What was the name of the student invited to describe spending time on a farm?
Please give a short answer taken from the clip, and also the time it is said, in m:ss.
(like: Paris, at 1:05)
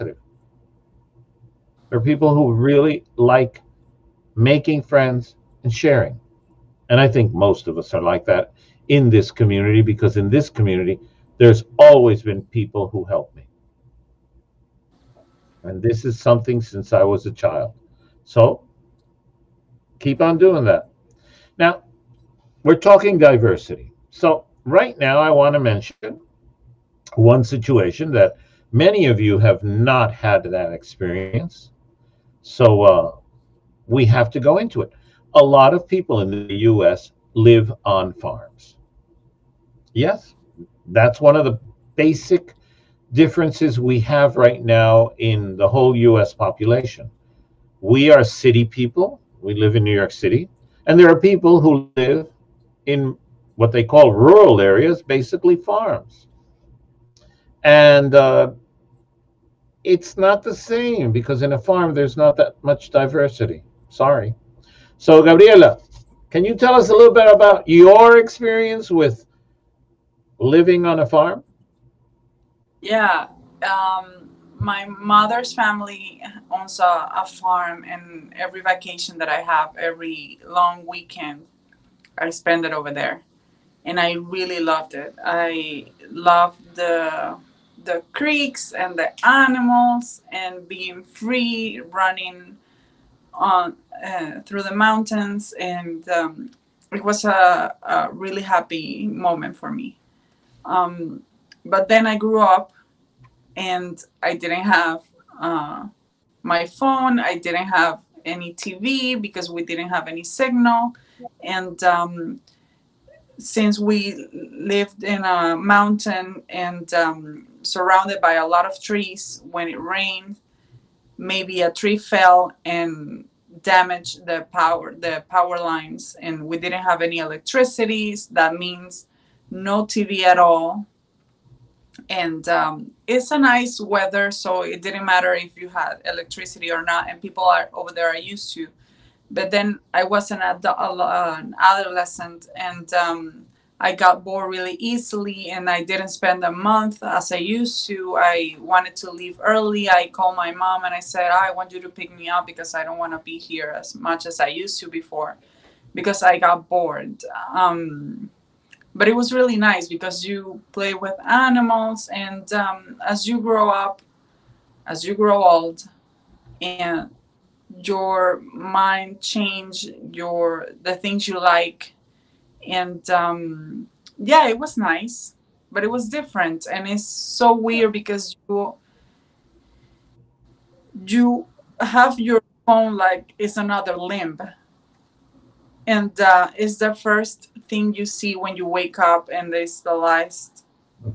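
Gabriela, at 1:05.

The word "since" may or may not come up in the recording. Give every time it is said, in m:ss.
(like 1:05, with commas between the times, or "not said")
0:16, 1:53.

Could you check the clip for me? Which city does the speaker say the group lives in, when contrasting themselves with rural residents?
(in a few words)
New York City.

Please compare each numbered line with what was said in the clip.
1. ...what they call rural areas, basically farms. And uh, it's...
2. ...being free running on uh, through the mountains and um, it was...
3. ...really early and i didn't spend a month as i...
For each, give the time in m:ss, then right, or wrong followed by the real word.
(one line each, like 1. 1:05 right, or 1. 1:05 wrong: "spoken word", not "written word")
1. 0:53 right
2. 1:30 right
3. 2:24 wrong: "easily", not "early".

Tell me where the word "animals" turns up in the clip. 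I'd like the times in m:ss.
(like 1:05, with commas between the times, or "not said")
1:29, 2:41.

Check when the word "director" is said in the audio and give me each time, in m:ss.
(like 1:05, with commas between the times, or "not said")
not said.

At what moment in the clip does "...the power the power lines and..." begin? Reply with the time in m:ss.
2:04.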